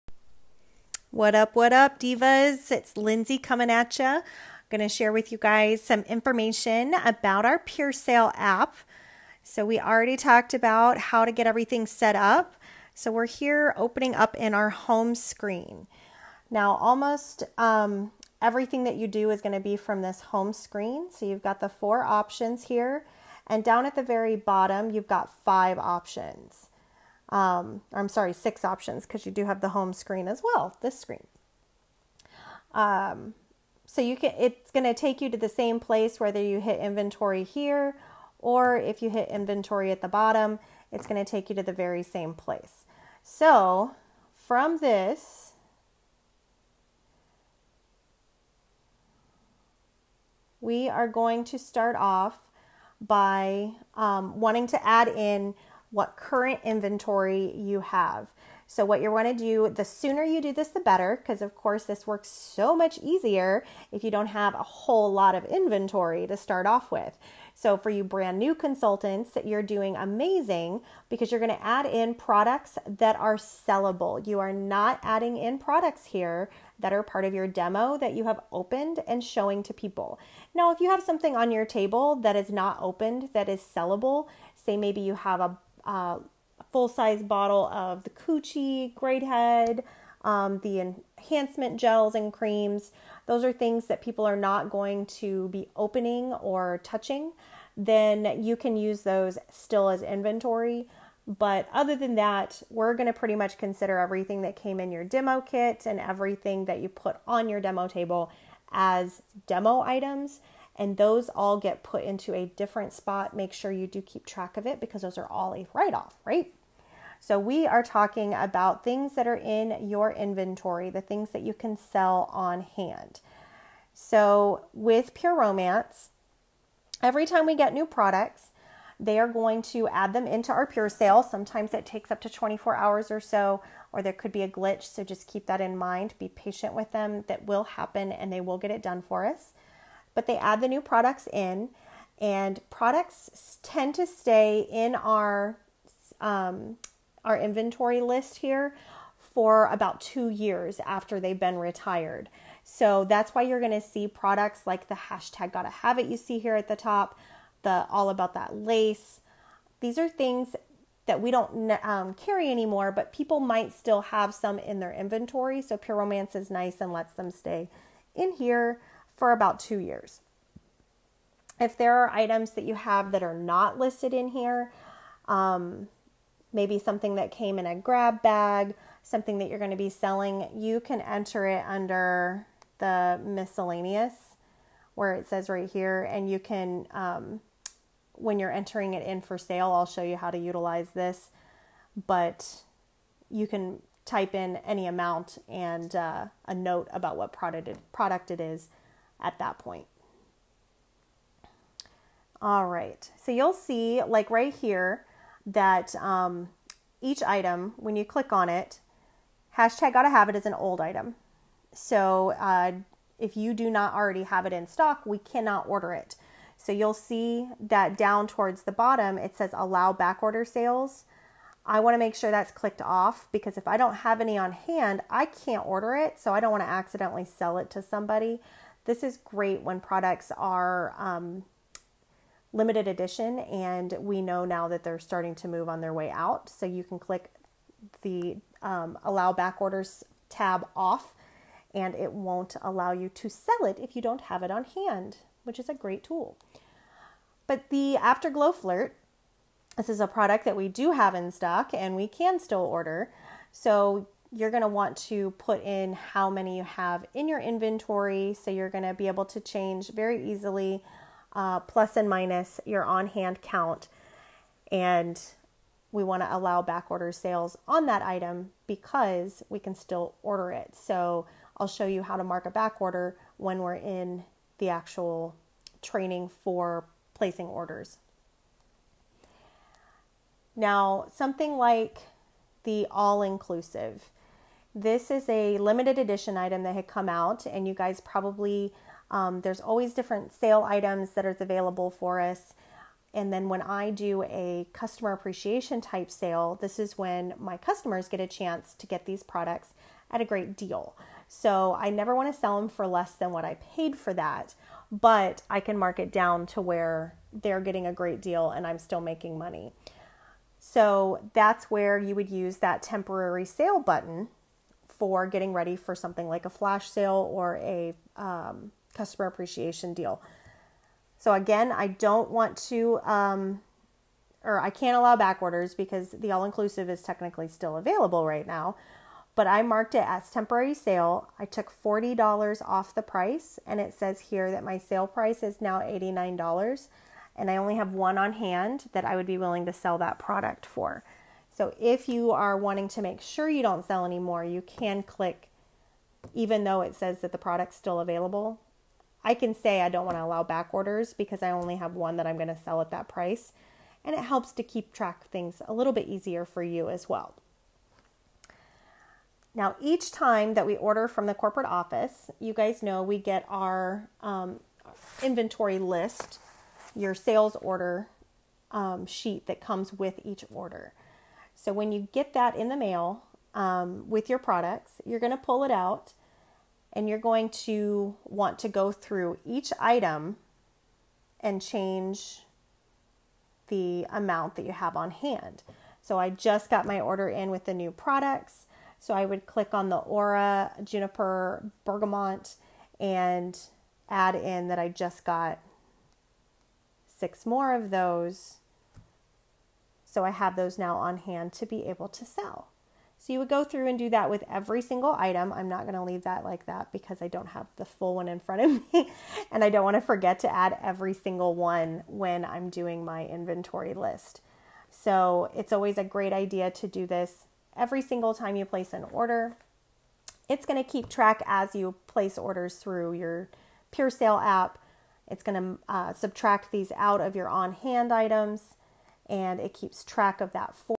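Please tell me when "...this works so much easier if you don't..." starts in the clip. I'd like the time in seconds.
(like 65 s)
61 s.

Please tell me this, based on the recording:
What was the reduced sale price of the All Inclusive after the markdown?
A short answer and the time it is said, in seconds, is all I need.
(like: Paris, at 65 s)
$89, at 335 s.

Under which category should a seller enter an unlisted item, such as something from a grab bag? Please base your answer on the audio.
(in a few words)
Miscellaneous.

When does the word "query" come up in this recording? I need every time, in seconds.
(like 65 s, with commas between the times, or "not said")
not said.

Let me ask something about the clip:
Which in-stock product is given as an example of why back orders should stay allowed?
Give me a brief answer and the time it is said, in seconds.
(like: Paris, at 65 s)
Afterglow Flirt, at 247 s.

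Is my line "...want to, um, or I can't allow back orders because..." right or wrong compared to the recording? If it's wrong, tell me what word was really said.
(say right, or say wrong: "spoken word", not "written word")
right.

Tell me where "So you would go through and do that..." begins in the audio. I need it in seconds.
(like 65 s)
403 s.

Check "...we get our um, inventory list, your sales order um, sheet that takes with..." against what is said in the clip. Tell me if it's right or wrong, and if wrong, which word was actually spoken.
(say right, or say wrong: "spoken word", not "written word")
wrong: "comes", not "takes".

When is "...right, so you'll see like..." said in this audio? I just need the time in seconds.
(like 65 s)
202 s.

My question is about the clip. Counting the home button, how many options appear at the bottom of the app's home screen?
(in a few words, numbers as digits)
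6.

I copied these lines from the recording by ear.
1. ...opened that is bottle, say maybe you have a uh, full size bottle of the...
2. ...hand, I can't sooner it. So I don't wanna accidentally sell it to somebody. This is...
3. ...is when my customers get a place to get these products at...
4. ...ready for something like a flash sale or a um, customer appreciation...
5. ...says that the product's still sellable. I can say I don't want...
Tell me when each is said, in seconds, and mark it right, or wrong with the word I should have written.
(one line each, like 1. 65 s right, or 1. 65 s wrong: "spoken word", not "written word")
1. 82 s wrong: "sellable", not "bottle"
2. 224 s wrong: "order", not "sooner"
3. 296 s wrong: "chance", not "place"
4. 315 s right
5. 346 s wrong: "available", not "sellable".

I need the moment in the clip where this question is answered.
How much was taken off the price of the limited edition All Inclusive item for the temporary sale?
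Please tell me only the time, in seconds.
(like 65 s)
331 s.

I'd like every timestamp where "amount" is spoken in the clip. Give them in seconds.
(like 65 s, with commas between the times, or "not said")
194 s, 384 s.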